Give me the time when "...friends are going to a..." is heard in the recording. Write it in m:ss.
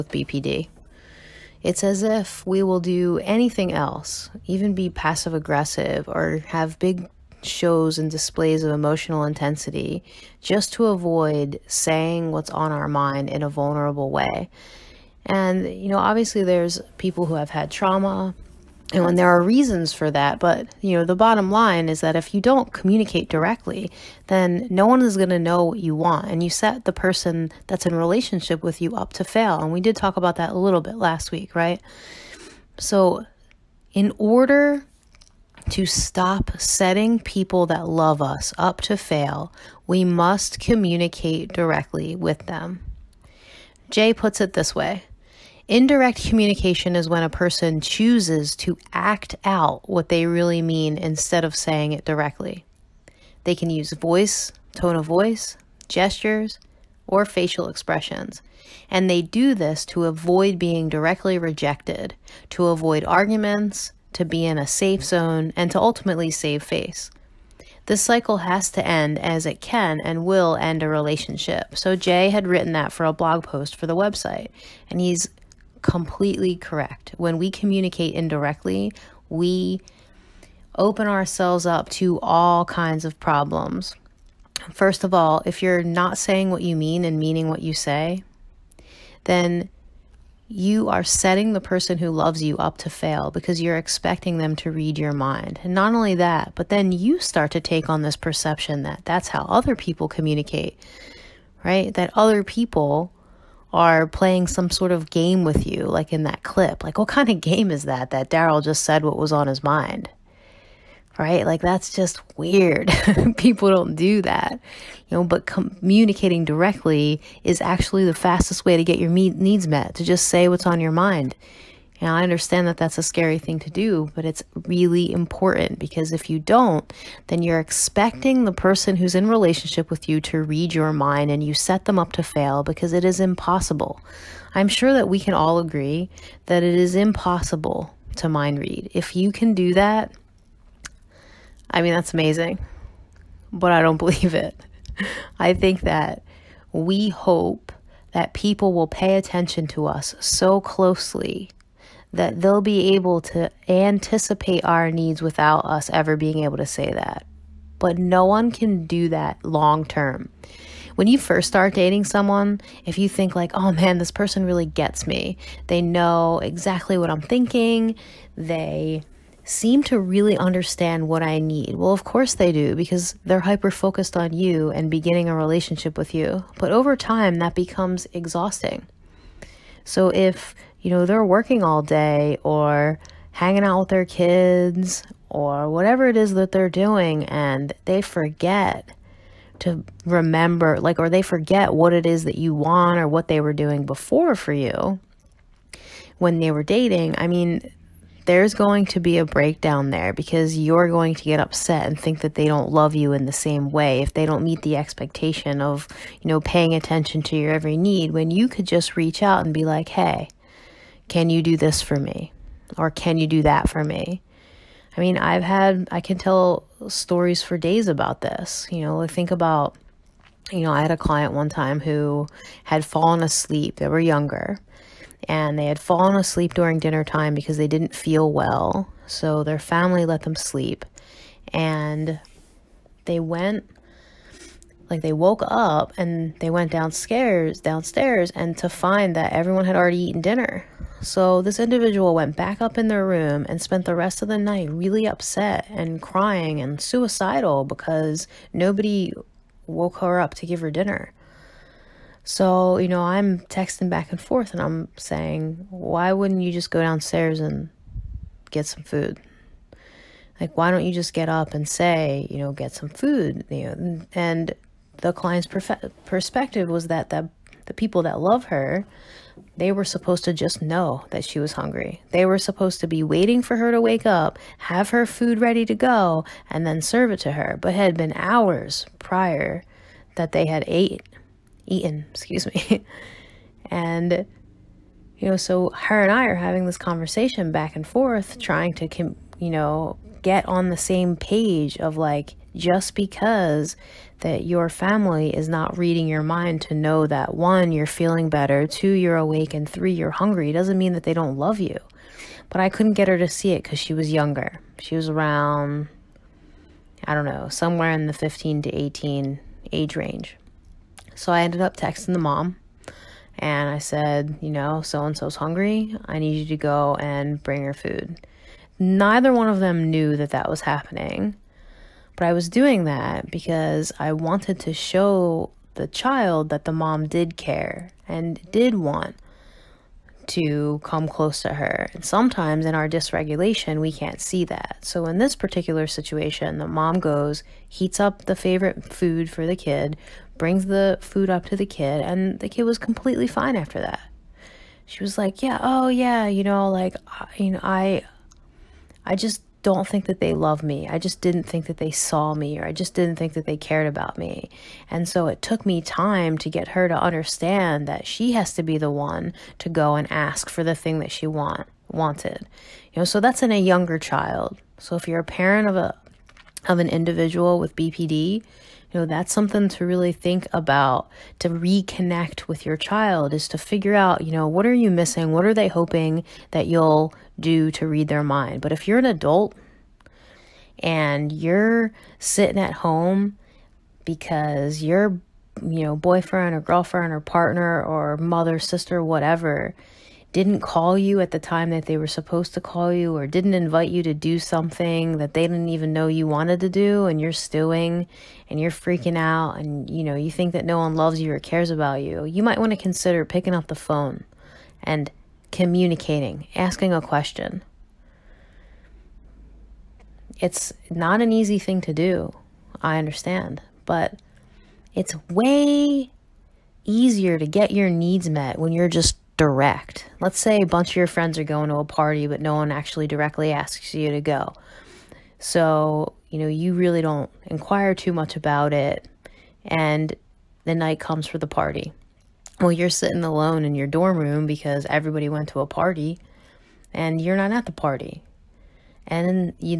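7:01.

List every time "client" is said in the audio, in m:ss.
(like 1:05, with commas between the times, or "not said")
3:40, 4:25.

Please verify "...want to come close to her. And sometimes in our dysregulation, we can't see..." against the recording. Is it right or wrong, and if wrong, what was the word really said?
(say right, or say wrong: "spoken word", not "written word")
right.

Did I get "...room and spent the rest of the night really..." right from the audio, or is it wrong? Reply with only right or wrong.
right.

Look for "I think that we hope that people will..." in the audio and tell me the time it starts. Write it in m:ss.
2:25.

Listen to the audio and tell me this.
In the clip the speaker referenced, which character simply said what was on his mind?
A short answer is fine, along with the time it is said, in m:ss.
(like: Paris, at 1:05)
Darryl, at 1:48.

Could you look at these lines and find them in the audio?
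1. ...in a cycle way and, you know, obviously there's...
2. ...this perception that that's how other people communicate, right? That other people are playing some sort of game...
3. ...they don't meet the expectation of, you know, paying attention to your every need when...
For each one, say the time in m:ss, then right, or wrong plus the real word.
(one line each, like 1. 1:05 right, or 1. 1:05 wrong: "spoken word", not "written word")
1. 0:13 wrong: "vulnerable", not "cycle"
2. 1:38 right
3. 3:24 right.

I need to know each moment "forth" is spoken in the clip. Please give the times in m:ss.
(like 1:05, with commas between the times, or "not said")
4:14, 4:47.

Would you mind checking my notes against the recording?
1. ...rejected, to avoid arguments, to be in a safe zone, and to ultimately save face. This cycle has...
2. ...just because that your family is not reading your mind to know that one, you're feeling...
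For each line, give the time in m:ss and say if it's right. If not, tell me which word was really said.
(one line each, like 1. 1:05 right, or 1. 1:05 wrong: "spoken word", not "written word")
1. 1:01 right
2. 4:52 right.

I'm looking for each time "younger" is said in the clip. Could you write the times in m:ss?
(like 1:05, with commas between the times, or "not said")
3:43, 5:04, 6:03.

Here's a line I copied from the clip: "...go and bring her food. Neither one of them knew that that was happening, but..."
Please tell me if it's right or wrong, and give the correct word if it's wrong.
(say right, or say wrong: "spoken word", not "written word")
right.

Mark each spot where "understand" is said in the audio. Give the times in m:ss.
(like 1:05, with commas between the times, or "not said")
2:02, 2:50, 5:57, 6:52.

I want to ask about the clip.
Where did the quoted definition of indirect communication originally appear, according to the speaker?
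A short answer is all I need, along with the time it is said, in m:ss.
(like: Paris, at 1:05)
a blog post, at 1:13.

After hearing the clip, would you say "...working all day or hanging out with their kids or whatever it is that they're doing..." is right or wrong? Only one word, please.
right.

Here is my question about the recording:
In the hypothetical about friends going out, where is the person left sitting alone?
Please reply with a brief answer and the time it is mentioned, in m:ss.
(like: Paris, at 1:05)
dorm room, at 7:13.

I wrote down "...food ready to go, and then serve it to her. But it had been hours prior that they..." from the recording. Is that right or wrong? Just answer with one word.
right.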